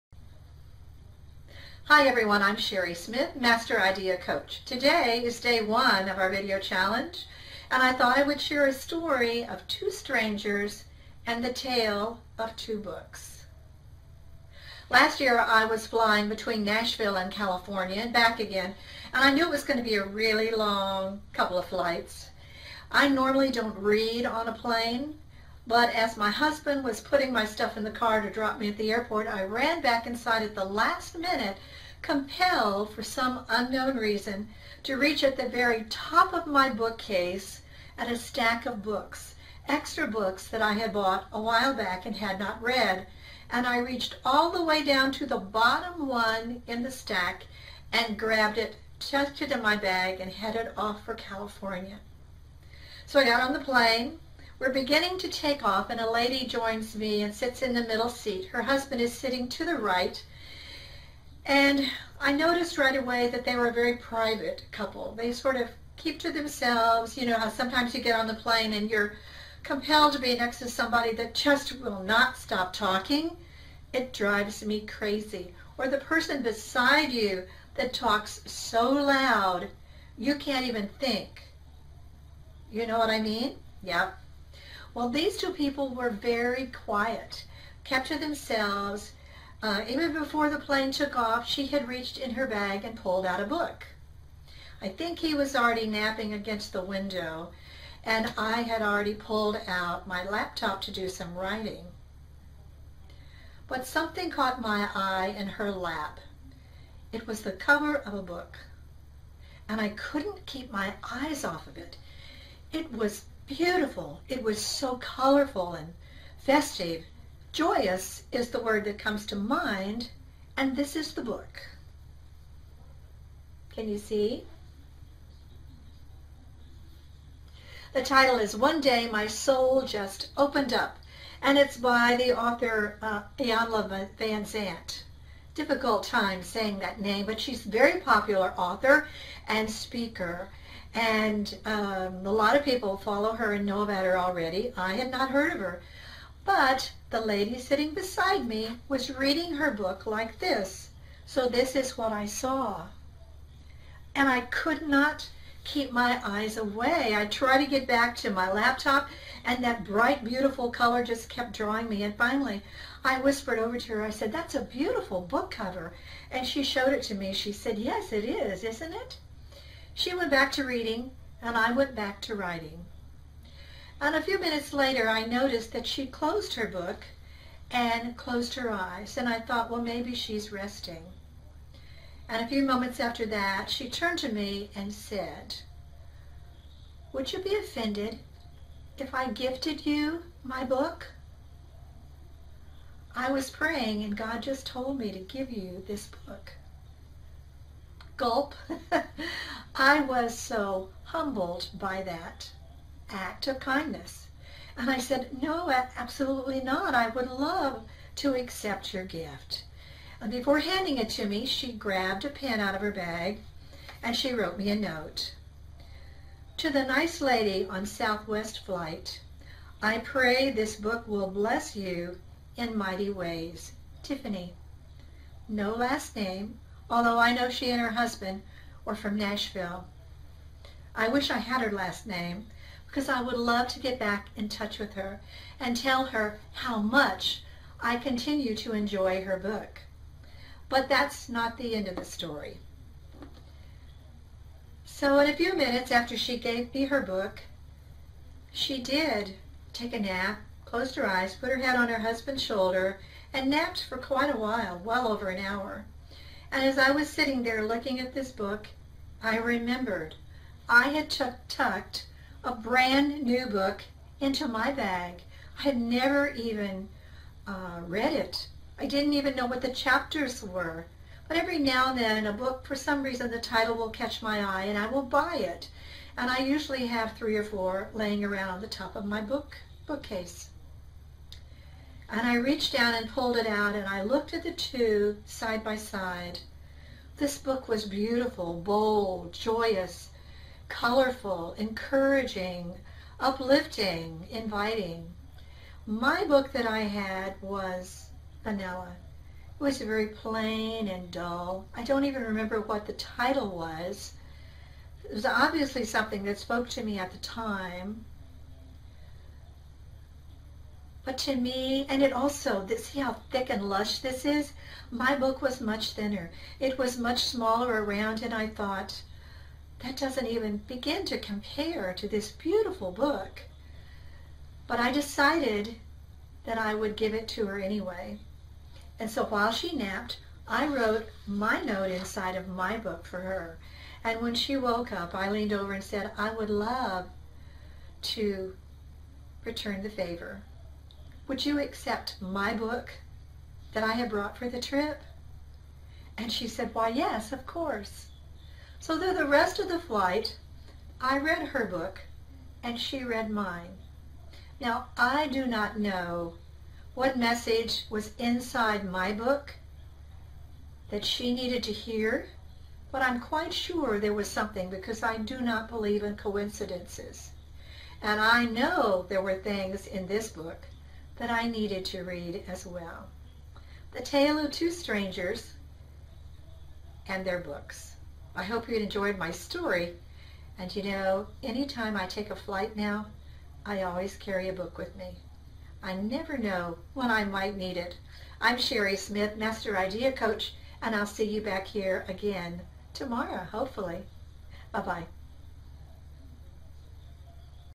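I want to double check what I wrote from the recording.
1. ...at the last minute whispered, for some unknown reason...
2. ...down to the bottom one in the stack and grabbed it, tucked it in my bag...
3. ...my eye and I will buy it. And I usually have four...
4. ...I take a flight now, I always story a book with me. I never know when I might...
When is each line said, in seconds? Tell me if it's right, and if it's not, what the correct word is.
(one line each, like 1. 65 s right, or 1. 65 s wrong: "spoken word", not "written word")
1. 30 s wrong: "compelled", not "whispered"
2. 44 s right
3. 274 s wrong: "three", not "four"
4. 381 s wrong: "carry", not "story".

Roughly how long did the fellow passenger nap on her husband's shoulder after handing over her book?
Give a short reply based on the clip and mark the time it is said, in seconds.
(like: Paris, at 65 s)
over an hour, at 254 s.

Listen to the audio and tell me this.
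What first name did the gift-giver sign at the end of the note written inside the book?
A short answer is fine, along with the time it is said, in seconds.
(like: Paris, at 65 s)
Tiffany, at 224 s.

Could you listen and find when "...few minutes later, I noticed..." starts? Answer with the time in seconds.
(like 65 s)
174 s.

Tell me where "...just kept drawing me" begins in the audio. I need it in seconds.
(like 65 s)
161 s.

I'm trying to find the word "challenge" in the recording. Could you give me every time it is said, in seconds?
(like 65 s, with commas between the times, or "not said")
6 s.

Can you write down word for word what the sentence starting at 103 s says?
But something caught my eye in her lap.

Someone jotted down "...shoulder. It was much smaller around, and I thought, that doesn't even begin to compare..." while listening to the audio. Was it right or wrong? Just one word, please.
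wrong.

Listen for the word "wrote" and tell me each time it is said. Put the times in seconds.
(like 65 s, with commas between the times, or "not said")
214 s, 330 s.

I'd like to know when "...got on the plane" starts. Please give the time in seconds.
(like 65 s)
53 s.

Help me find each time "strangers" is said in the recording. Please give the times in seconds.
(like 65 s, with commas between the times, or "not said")
9 s, 374 s.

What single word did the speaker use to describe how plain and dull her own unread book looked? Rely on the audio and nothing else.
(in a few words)
Vanilla.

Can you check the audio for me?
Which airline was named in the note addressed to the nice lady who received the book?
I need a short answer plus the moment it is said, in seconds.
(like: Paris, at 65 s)
Southwest, at 217 s.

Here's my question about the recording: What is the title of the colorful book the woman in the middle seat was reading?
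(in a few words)
One Day My Soul Just Opened Up.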